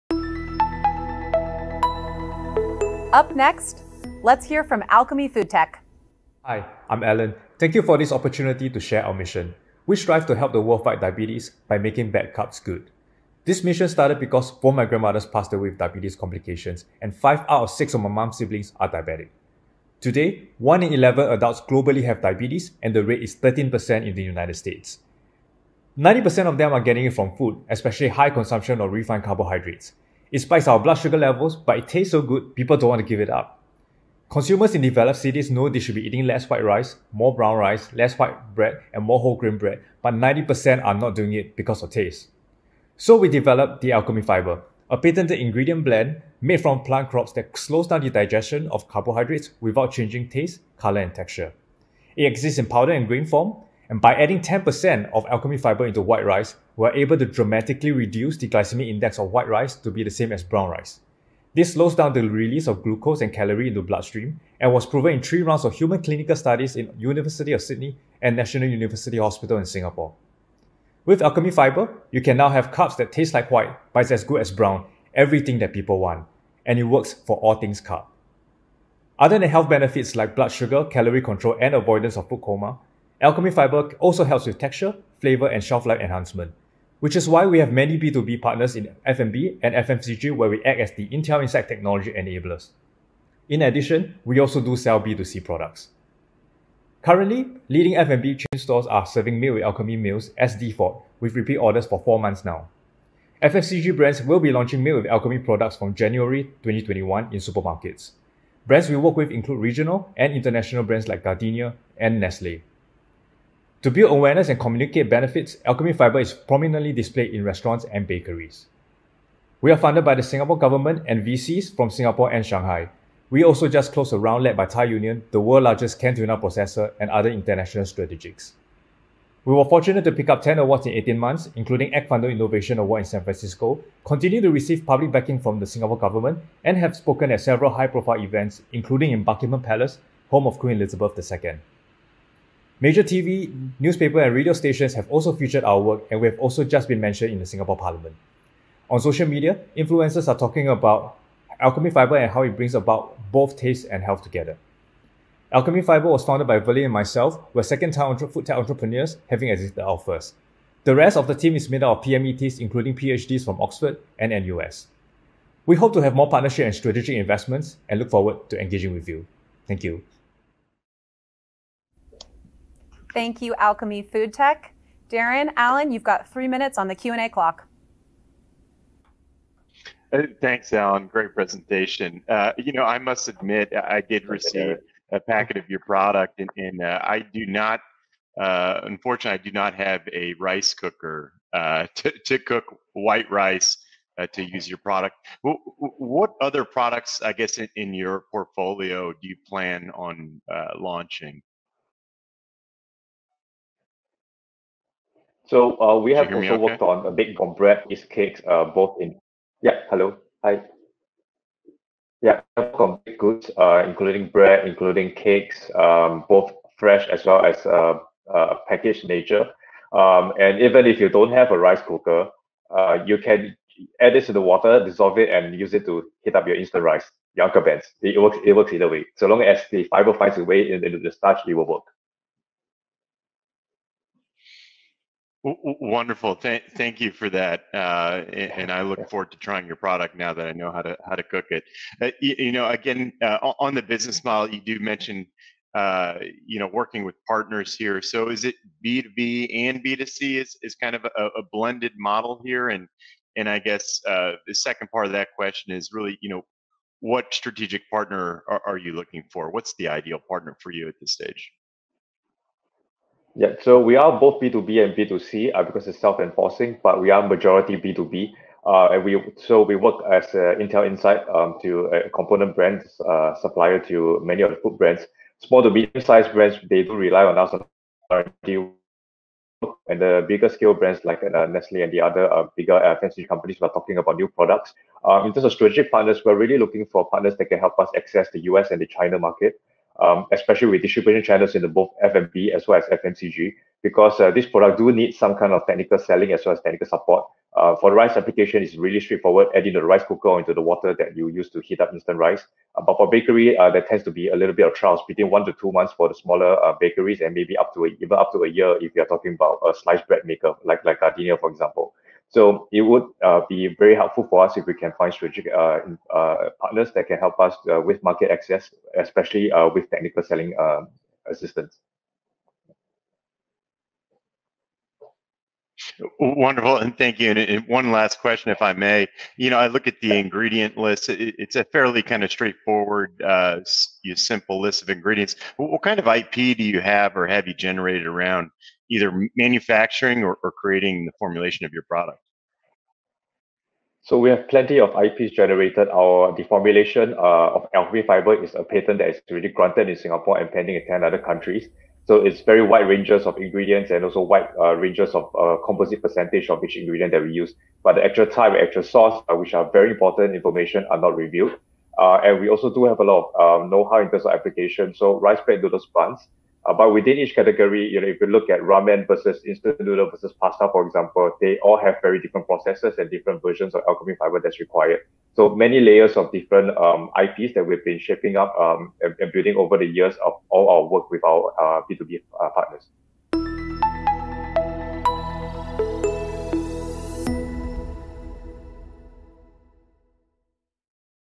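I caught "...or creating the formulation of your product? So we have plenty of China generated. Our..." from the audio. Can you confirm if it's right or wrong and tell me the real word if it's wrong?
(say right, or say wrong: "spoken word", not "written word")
wrong: "IPs", not "China".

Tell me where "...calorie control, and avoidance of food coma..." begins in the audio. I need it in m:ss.
1:20.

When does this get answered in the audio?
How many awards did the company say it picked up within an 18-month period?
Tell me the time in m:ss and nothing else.
2:10.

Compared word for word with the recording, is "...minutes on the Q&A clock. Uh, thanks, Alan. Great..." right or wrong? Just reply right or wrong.
right.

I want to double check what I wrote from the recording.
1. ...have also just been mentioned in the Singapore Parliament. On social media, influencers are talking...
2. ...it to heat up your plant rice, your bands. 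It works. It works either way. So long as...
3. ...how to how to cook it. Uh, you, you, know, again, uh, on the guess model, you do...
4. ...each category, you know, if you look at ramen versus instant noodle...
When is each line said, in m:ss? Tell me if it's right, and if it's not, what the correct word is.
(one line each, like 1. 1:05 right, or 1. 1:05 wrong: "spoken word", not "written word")
1. 2:26 right
2. 3:45 wrong: "instant", not "plant"
3. 4:00 wrong: "business", not "guess"
4. 6:07 right.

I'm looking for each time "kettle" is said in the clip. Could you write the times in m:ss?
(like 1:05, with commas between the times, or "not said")
not said.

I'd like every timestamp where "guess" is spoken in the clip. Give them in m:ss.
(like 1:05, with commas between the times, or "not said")
3:17, 4:13.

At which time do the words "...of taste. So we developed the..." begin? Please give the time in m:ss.
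0:41.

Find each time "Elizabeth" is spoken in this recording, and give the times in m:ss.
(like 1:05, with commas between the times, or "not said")
2:20.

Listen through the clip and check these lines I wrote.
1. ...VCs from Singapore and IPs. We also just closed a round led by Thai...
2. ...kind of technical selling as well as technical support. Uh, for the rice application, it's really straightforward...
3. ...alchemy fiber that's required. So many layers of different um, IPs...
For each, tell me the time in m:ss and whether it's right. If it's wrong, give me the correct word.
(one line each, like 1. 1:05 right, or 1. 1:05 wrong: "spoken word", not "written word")
1. 2:01 wrong: "Shanghai", not "IPs"
2. 4:55 right
3. 6:13 right.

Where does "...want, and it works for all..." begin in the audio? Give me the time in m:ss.
1:15.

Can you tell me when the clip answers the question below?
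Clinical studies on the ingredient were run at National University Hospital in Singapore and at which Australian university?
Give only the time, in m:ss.
1:06.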